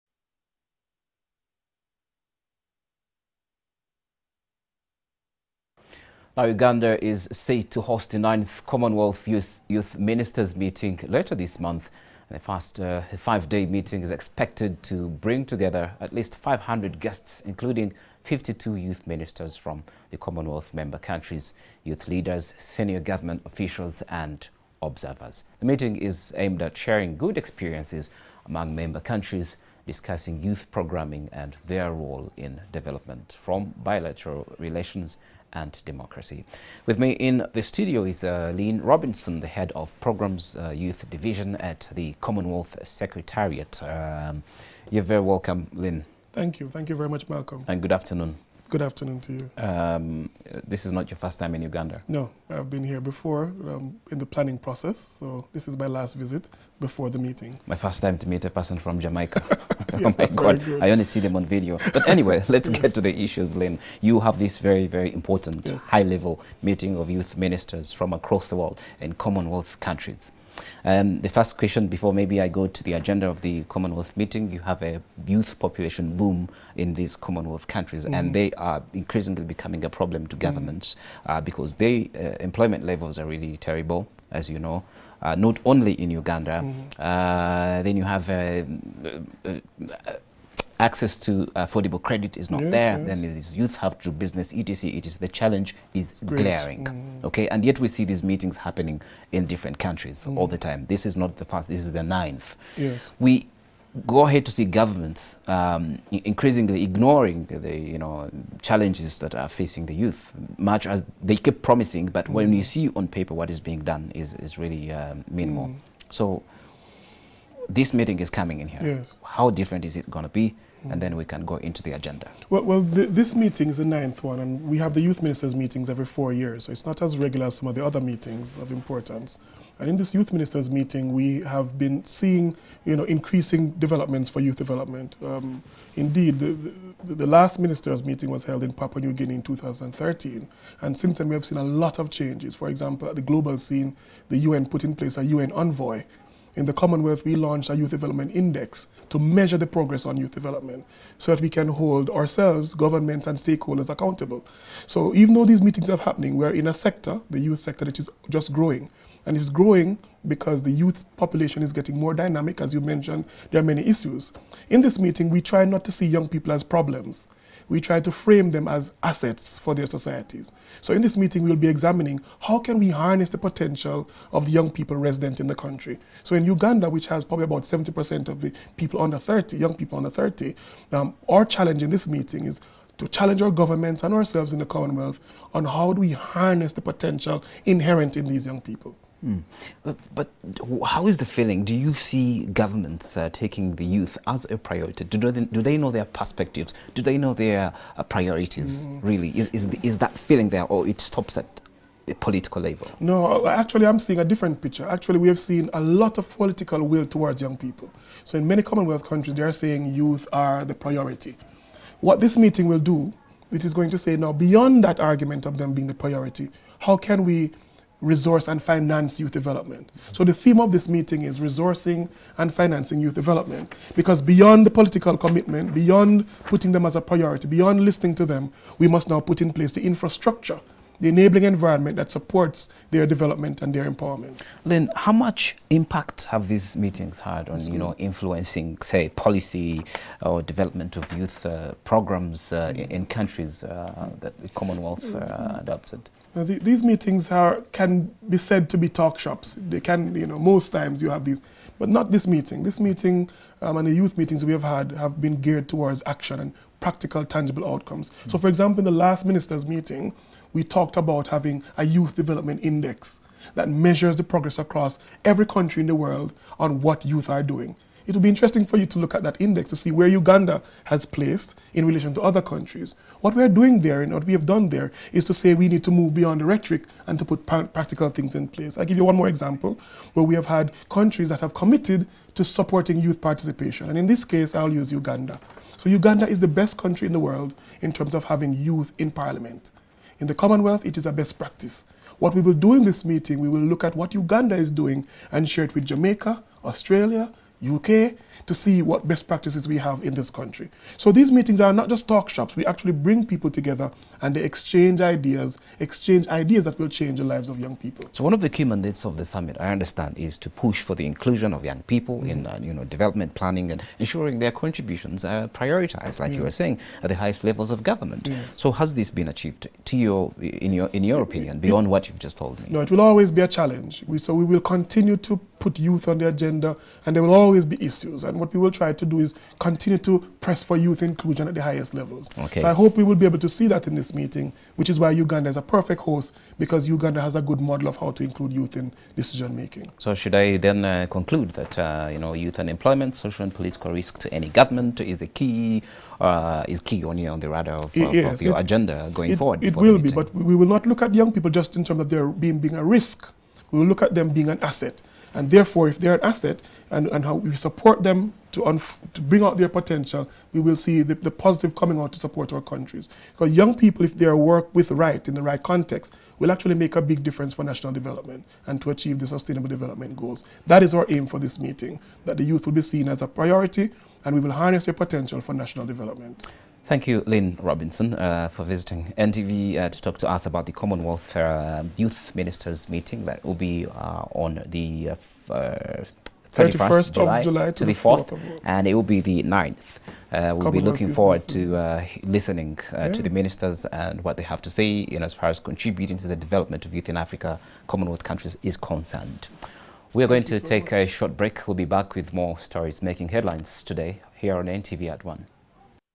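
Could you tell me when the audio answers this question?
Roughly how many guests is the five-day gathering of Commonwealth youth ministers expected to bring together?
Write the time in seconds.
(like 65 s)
16 s.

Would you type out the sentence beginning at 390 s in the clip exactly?
Uh, we'll be looking forward to uh, listening uh, yeah.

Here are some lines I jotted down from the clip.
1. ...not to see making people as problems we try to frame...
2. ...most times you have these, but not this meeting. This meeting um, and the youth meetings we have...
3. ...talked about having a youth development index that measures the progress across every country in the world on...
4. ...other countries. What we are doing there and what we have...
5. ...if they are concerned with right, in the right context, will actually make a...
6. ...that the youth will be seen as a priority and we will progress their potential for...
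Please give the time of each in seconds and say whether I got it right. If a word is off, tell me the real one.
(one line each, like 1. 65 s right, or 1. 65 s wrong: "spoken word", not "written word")
1. 165 s wrong: "young", not "making"
2. 250 s right
3. 260 s right
4. 272 s right
5. 364 s wrong: "worked", not "concerned"
6. 372 s wrong: "harness", not "progress".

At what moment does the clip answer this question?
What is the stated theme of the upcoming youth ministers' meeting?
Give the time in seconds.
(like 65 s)
221 s.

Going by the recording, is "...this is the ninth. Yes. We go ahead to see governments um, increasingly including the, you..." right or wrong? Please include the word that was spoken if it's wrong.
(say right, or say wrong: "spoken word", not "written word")
wrong: "ignoring", not "including".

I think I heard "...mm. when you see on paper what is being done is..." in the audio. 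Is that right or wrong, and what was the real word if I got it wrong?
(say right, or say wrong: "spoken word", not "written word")
right.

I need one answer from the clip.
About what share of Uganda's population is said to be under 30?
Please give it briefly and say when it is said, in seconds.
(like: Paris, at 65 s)
70%, at 177 s.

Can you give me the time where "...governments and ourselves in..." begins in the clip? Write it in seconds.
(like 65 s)
183 s.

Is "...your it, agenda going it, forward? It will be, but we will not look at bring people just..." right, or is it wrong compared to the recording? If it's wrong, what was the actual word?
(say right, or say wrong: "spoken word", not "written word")
wrong: "young", not "bring".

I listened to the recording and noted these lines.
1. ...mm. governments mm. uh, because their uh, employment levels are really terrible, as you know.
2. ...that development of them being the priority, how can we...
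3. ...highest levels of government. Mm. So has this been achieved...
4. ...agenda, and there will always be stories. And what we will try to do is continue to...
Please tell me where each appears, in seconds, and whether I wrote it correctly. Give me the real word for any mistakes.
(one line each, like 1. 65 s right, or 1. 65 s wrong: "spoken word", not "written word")
1. 80 s right
2. 214 s wrong: "argument", not "development"
3. 317 s right
4. 326 s wrong: "issues", not "stories".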